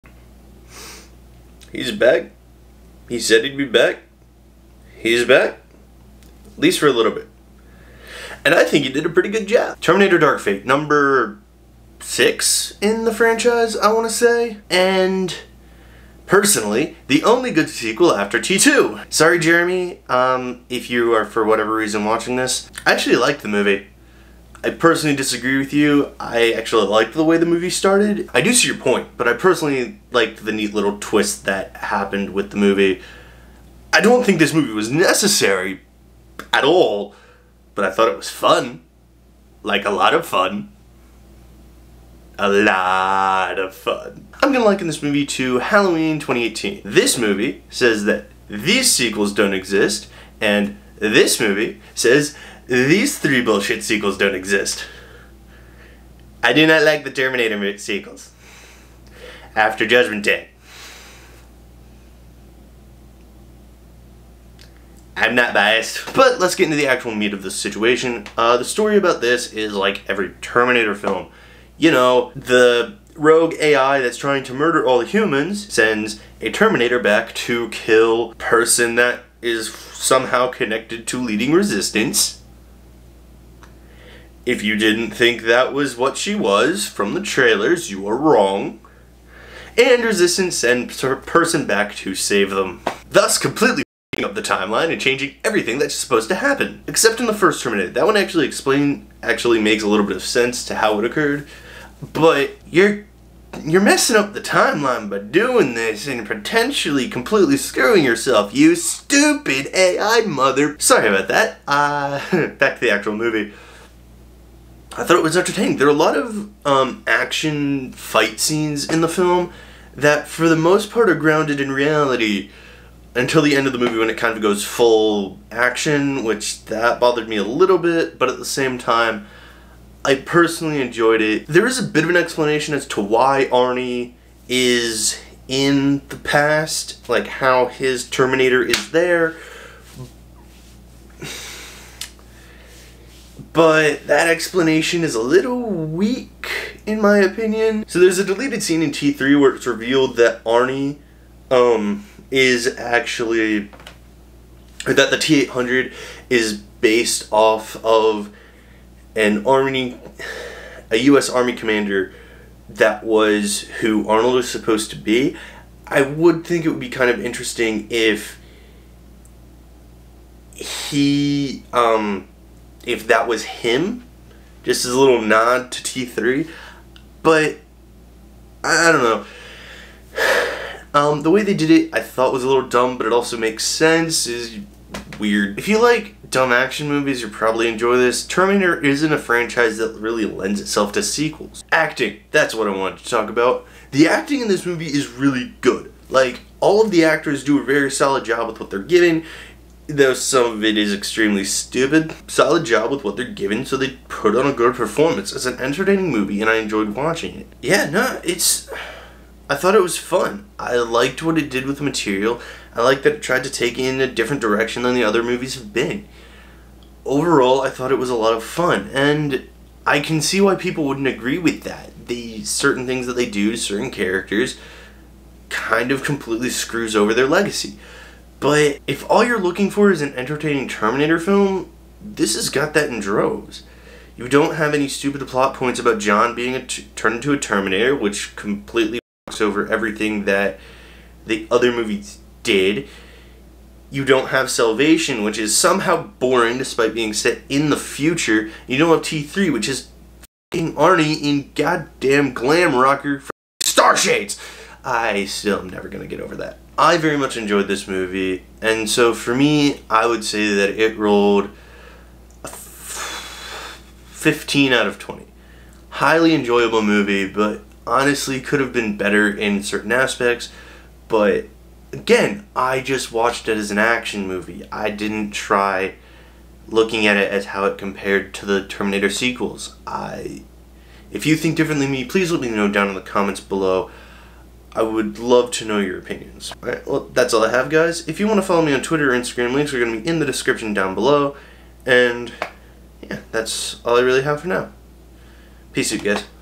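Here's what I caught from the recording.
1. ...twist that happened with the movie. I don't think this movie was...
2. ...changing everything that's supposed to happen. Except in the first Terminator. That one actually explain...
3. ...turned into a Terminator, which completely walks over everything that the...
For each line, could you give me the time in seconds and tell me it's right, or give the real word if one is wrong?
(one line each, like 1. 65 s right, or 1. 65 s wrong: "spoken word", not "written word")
1. 30 s right
2. 94 s right
3. 236 s right.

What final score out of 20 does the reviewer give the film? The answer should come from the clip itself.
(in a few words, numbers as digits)
15.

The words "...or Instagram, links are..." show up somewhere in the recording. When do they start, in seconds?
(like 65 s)
289 s.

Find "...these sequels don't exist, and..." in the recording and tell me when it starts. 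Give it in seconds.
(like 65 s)
48 s.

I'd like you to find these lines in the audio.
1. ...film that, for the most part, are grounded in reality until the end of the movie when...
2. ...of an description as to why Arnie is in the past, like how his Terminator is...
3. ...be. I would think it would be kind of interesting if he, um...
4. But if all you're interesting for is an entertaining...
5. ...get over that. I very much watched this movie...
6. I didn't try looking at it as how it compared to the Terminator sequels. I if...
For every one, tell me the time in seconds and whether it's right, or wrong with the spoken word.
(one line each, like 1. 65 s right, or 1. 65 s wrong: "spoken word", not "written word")
1. 119 s right
2. 132 s wrong: "explanation", not "description"
3. 164 s right
4. 228 s wrong: "looking", not "interesting"
5. 256 s wrong: "enjoyed", not "watched"
6. 274 s right.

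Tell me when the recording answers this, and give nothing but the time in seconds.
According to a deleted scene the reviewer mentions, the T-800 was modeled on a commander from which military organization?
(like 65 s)
160 s.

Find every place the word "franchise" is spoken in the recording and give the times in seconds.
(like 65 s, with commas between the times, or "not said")
13 s, 189 s.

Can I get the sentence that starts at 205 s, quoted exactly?
It's an entertaining movie, and I enjoyed watching it.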